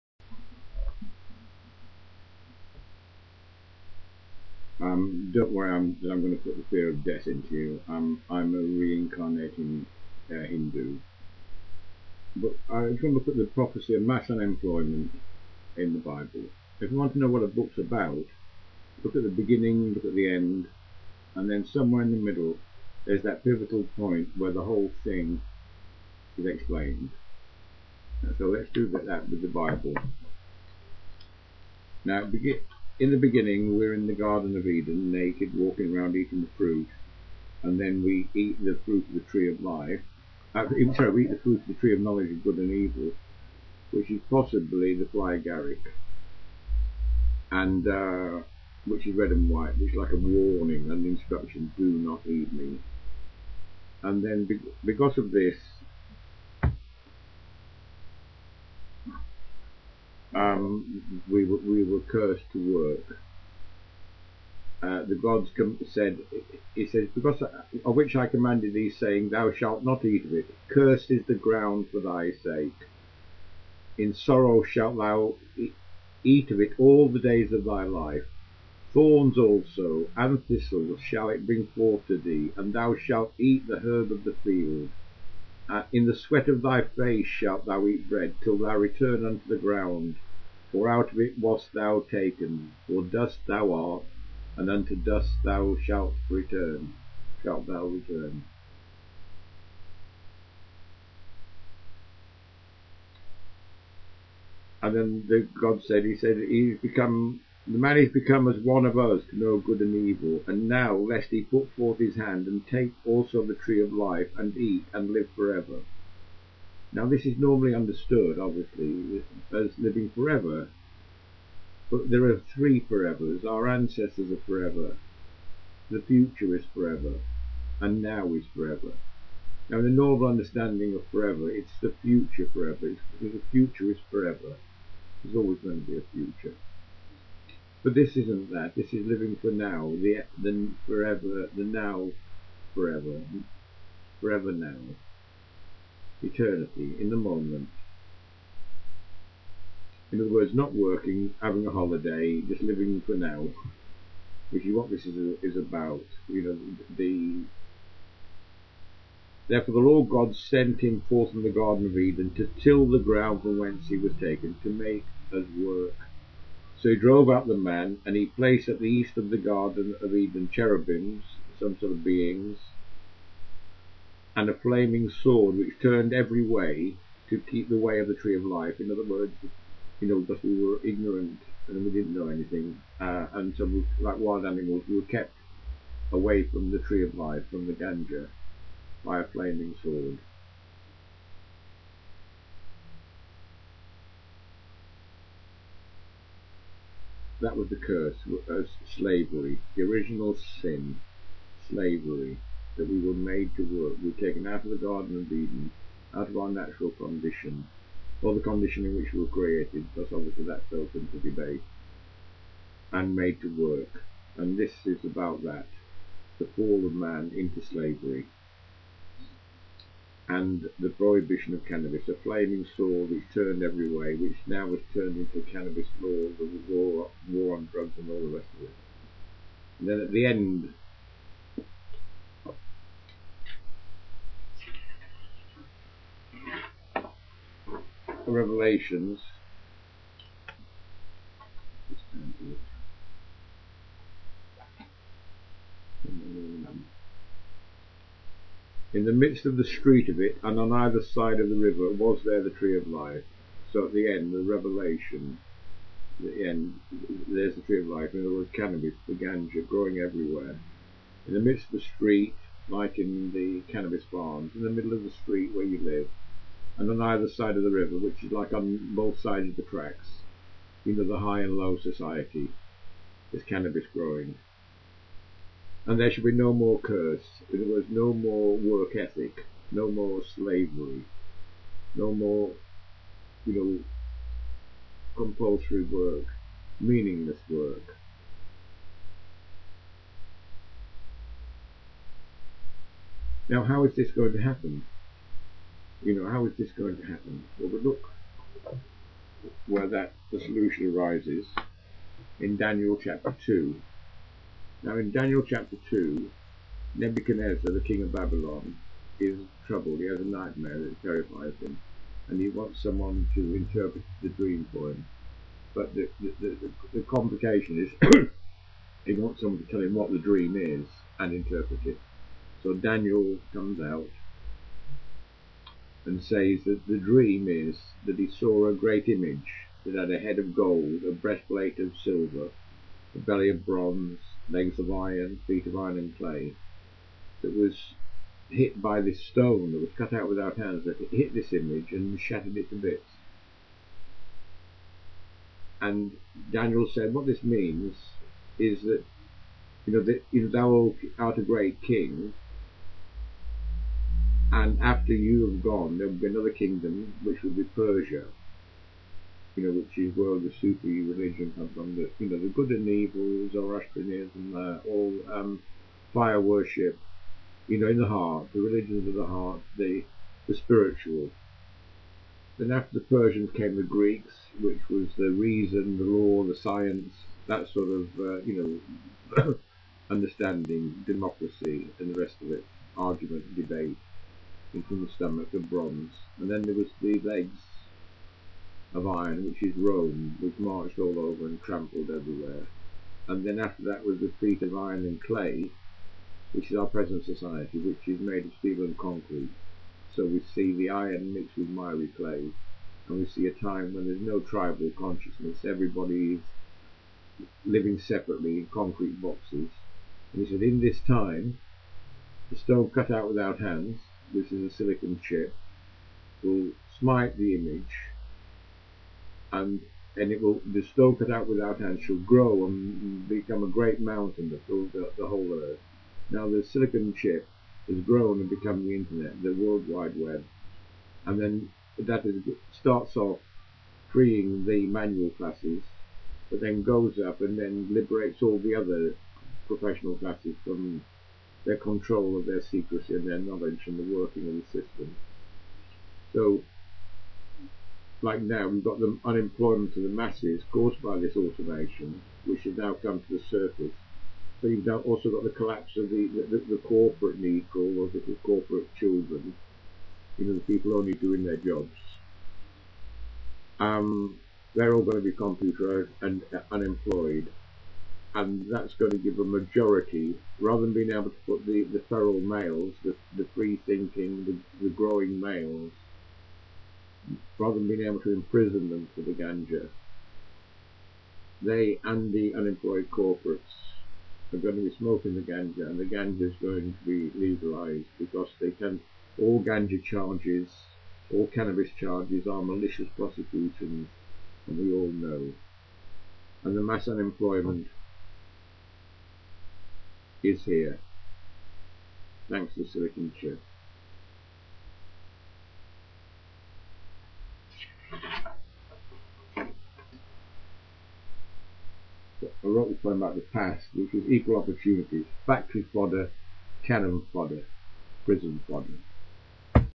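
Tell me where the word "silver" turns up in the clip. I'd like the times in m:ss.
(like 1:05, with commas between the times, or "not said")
5:32.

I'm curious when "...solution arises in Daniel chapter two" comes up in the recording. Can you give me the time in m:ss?
5:00.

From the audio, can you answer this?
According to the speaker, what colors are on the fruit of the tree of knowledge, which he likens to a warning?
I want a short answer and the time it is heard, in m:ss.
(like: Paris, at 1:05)
Red and white, at 0:49.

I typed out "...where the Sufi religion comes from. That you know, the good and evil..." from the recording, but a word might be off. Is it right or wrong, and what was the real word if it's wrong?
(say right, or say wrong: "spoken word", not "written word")
right.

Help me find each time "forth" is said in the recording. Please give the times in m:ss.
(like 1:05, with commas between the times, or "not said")
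1:21, 1:51, 2:41.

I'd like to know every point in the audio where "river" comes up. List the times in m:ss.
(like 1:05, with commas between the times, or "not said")
4:11, 4:27.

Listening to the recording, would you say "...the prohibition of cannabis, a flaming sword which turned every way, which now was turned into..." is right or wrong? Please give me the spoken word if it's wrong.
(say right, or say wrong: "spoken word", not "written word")
right.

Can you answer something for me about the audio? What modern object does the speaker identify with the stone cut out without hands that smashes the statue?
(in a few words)
A silicon chip.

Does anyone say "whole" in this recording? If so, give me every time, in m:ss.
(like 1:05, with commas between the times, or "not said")
0:24, 7:05.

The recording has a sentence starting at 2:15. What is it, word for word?
There's always going to be a future.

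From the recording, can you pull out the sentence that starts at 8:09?
All ganja charges, all cannabis charges, are malicious prosecutions, and we all know.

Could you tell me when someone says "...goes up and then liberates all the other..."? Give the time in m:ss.
7:16.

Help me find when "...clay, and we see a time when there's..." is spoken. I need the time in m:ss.
6:42.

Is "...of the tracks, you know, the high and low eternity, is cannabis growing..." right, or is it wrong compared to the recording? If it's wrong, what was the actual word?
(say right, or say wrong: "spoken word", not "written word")
wrong: "society", not "eternity".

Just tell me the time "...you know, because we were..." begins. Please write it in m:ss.
2:59.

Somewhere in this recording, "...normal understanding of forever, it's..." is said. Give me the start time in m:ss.
2:09.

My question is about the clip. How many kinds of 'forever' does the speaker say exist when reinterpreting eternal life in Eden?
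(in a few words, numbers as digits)
3.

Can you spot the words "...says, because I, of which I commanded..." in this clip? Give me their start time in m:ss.
1:06.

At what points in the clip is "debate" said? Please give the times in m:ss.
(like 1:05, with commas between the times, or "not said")
3:31, 6:23.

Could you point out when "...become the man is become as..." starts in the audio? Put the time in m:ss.
1:46.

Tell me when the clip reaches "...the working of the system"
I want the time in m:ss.
7:23.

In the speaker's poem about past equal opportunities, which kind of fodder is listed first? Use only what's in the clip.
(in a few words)
Factory fodder.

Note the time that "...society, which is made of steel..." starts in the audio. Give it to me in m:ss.
6:37.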